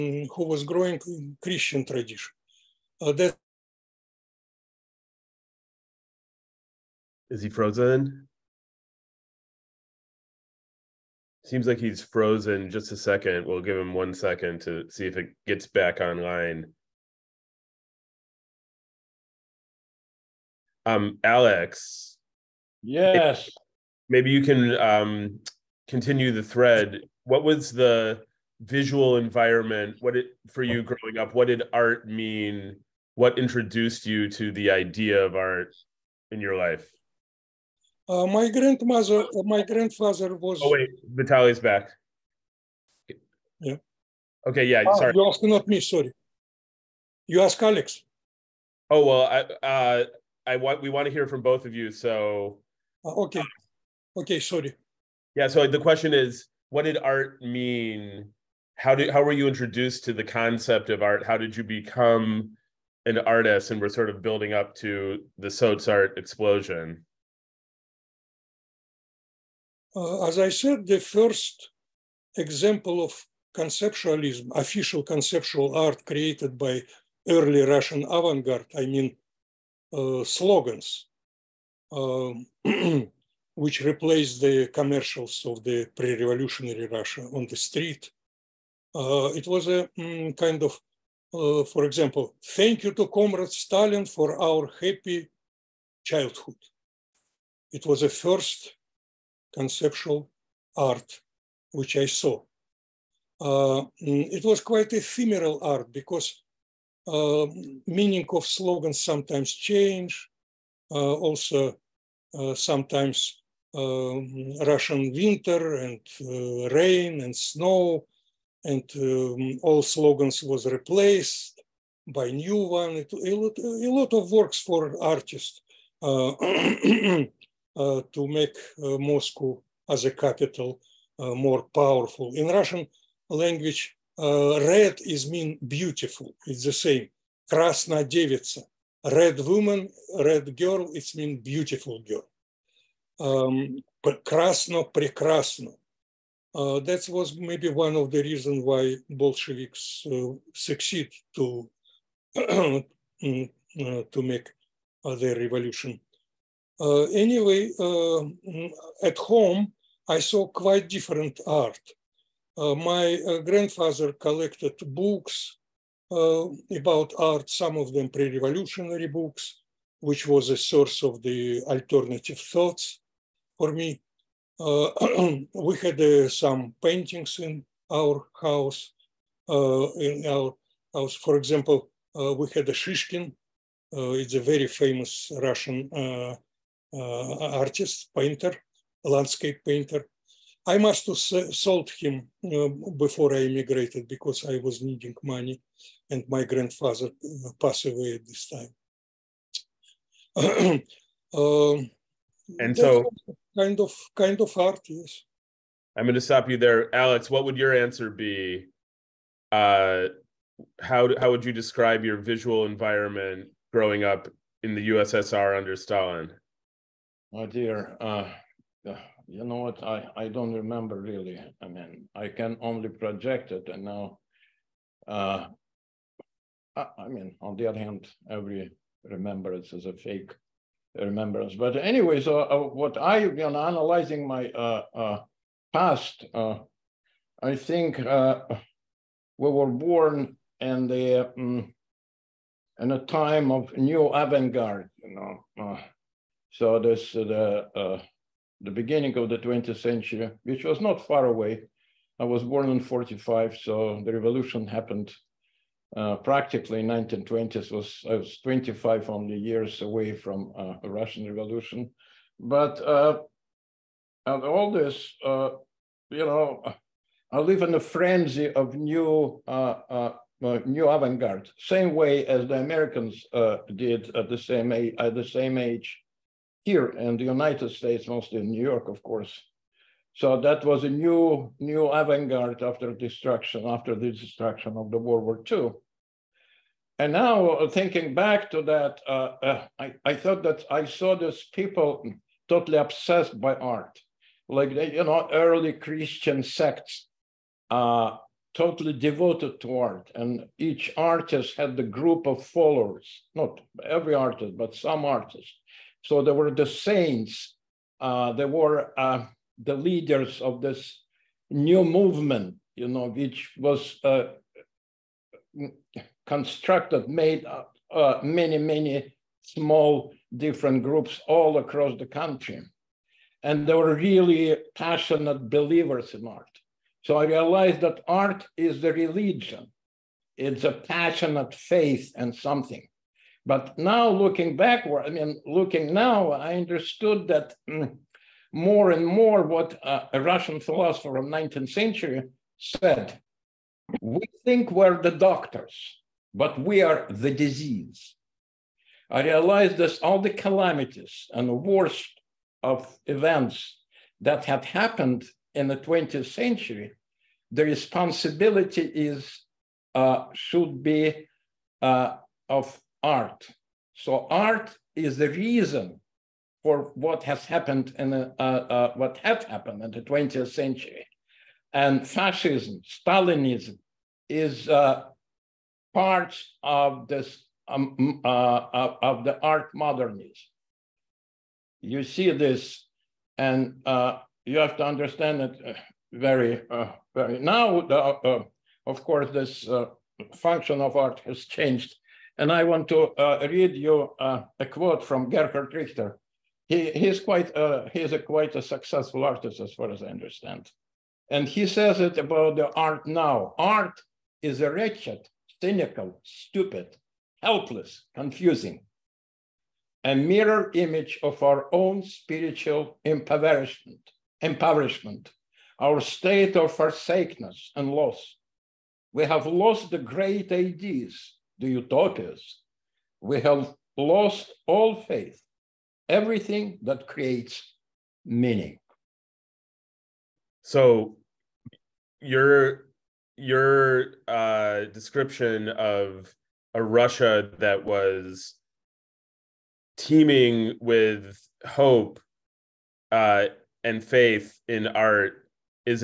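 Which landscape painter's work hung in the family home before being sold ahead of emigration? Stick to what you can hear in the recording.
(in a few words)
Shishkin.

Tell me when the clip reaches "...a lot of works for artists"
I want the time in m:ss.
2:03.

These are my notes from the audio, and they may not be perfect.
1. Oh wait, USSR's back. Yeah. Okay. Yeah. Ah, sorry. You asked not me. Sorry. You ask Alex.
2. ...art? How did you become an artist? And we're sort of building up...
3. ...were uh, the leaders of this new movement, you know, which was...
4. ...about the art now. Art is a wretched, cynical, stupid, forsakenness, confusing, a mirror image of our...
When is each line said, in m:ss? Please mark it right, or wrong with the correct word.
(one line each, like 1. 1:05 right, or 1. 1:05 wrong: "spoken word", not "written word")
1. 0:40 wrong: "Vitaly", not "USSR"
2. 1:01 right
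3. 5:08 right
4. 6:42 wrong: "helpless", not "forsakenness".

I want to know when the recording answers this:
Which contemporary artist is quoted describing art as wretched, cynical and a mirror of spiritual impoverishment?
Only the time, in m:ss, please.
6:35.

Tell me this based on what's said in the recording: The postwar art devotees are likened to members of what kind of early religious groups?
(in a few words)
early Christian sects.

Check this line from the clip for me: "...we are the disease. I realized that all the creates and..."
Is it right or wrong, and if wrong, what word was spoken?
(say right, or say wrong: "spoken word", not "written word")
wrong: "calamities", not "creates".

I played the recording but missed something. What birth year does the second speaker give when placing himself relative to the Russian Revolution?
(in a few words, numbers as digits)
1945.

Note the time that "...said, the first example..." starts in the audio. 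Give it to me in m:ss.
1:10.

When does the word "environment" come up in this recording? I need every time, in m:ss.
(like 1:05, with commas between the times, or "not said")
0:29, 3:32.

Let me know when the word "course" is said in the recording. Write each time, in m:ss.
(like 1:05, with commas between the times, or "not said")
4:39, 6:29.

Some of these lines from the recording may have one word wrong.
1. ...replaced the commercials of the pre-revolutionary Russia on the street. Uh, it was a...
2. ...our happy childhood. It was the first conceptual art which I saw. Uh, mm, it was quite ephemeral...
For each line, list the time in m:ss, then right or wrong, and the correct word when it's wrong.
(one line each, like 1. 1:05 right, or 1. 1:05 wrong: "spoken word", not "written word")
1. 1:23 right
2. 1:34 right.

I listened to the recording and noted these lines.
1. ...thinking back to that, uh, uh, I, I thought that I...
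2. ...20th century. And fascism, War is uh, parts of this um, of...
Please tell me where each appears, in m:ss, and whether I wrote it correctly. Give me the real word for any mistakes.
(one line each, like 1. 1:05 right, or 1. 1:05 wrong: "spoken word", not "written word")
1. 4:47 right
2. 6:10 wrong: "Stalinism", not "War".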